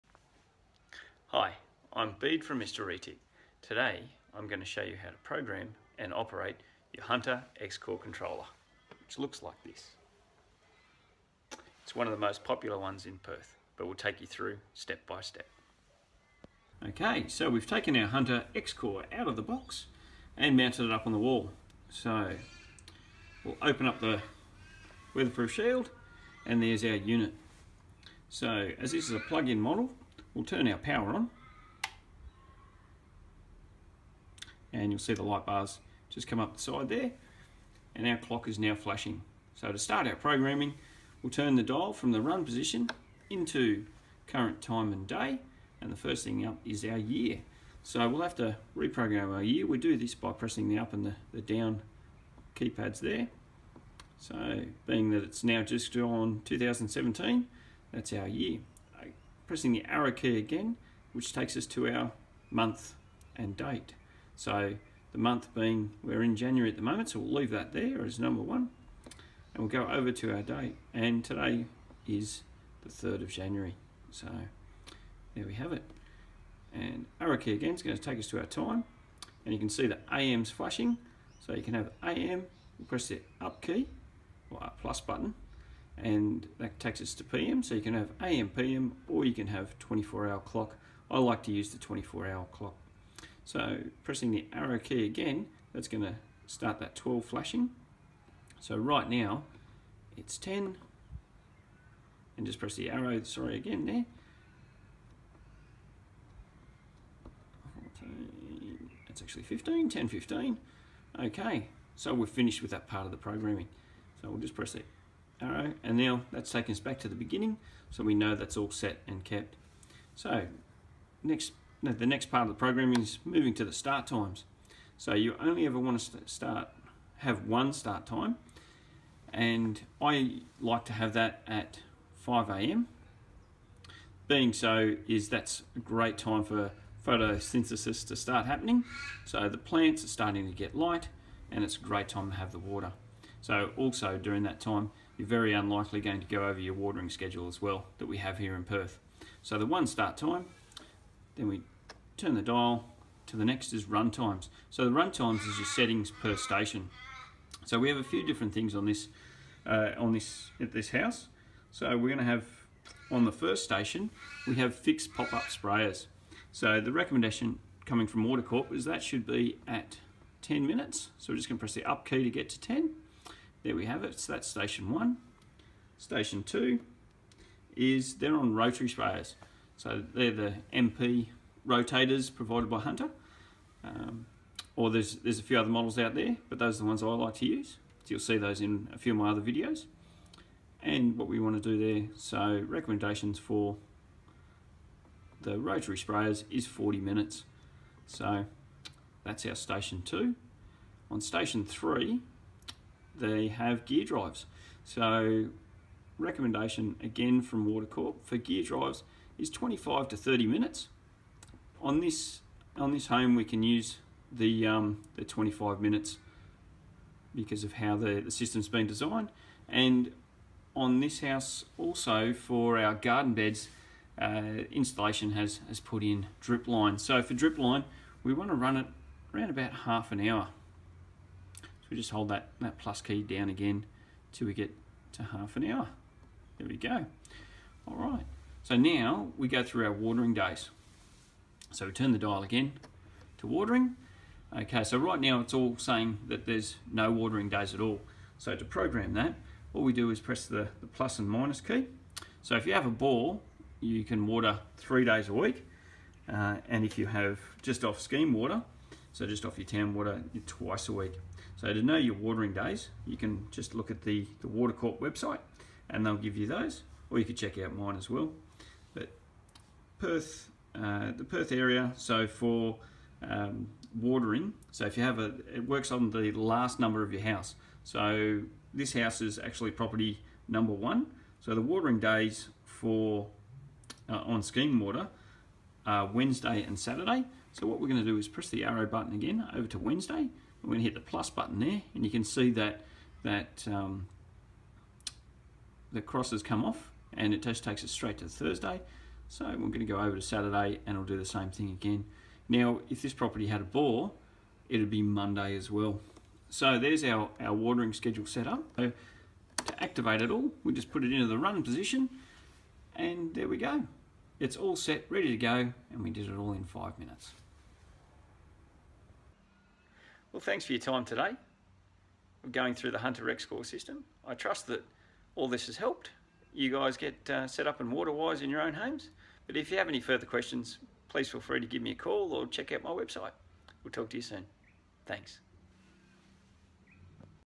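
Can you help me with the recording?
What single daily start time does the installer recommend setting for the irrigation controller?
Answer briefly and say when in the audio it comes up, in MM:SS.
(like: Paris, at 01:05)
5 a.m., at 02:12.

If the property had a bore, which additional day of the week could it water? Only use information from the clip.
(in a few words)
Monday.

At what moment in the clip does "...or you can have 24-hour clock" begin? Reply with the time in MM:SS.
01:29.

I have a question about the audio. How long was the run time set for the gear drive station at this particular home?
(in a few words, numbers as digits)
25 minutes.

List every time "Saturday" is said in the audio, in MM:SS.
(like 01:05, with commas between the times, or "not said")
04:46, 05:00.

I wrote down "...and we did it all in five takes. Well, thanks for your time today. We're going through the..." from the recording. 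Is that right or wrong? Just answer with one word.
wrong.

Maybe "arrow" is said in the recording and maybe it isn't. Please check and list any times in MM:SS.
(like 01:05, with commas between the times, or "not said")
00:59, 01:17, 01:34, 01:42, 04:48.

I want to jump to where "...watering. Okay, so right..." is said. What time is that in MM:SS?
04:03.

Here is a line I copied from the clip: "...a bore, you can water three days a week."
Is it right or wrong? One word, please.
right.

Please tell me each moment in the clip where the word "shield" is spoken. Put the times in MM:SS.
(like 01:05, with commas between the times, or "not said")
00:25.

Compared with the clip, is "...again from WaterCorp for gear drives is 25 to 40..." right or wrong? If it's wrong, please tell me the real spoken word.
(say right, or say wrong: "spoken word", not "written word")
wrong: "30", not "40".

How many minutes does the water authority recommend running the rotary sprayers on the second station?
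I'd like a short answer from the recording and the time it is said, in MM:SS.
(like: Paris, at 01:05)
40 minutes, at 03:16.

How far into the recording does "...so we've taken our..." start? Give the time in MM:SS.
00:17.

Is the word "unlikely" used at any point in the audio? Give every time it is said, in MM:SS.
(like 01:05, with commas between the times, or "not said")
02:25.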